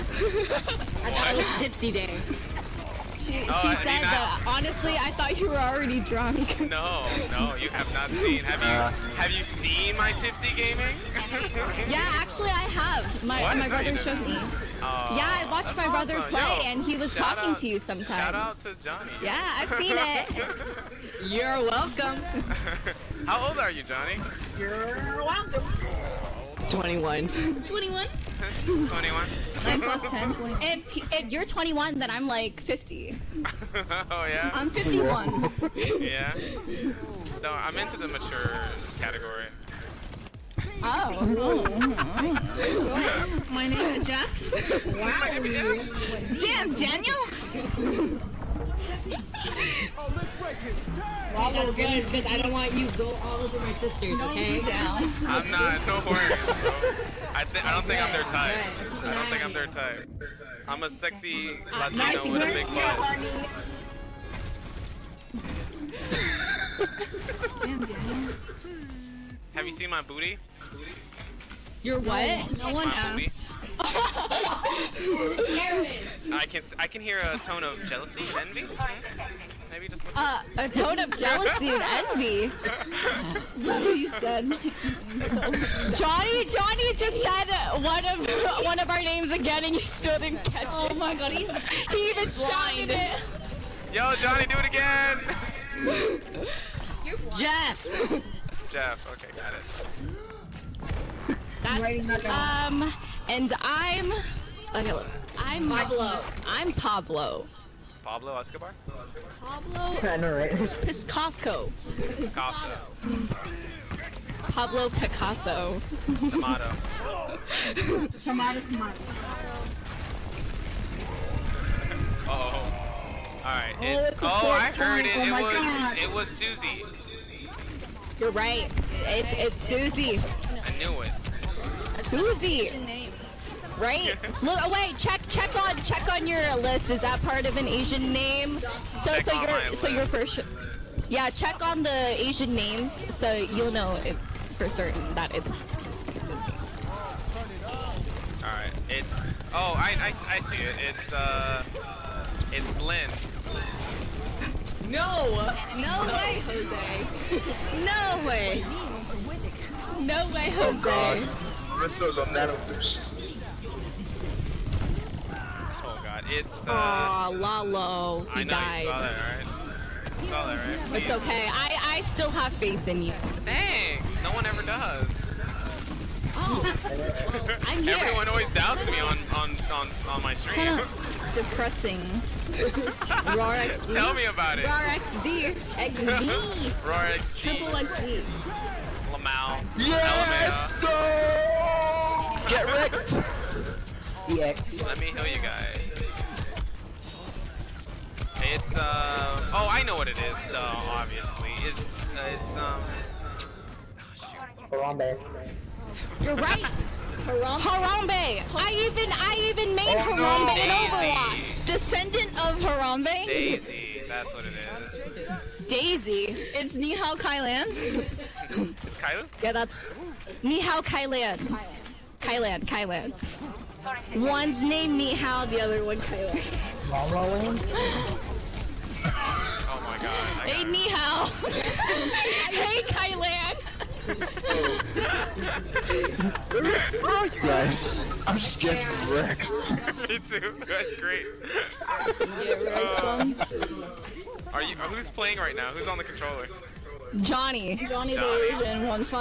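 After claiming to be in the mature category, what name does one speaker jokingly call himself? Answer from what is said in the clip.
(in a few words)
Jack.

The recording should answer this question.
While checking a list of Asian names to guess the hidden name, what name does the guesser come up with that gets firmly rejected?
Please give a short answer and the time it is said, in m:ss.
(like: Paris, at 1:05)
Lynn, at 2:32.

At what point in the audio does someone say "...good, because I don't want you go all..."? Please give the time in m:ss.
0:51.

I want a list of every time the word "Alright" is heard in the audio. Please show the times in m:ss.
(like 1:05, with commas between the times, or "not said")
2:03, 2:28.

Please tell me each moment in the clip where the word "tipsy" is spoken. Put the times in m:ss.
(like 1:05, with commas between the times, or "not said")
0:01, 0:10.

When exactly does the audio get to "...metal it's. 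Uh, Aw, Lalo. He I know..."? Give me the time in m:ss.
2:42.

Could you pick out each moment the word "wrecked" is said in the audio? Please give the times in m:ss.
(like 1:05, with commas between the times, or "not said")
3:12, 3:59.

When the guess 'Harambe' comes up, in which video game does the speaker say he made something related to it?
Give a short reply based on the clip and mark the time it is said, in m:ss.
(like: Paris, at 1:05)
Overwatch, at 3:31.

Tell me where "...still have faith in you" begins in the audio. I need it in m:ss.
2:52.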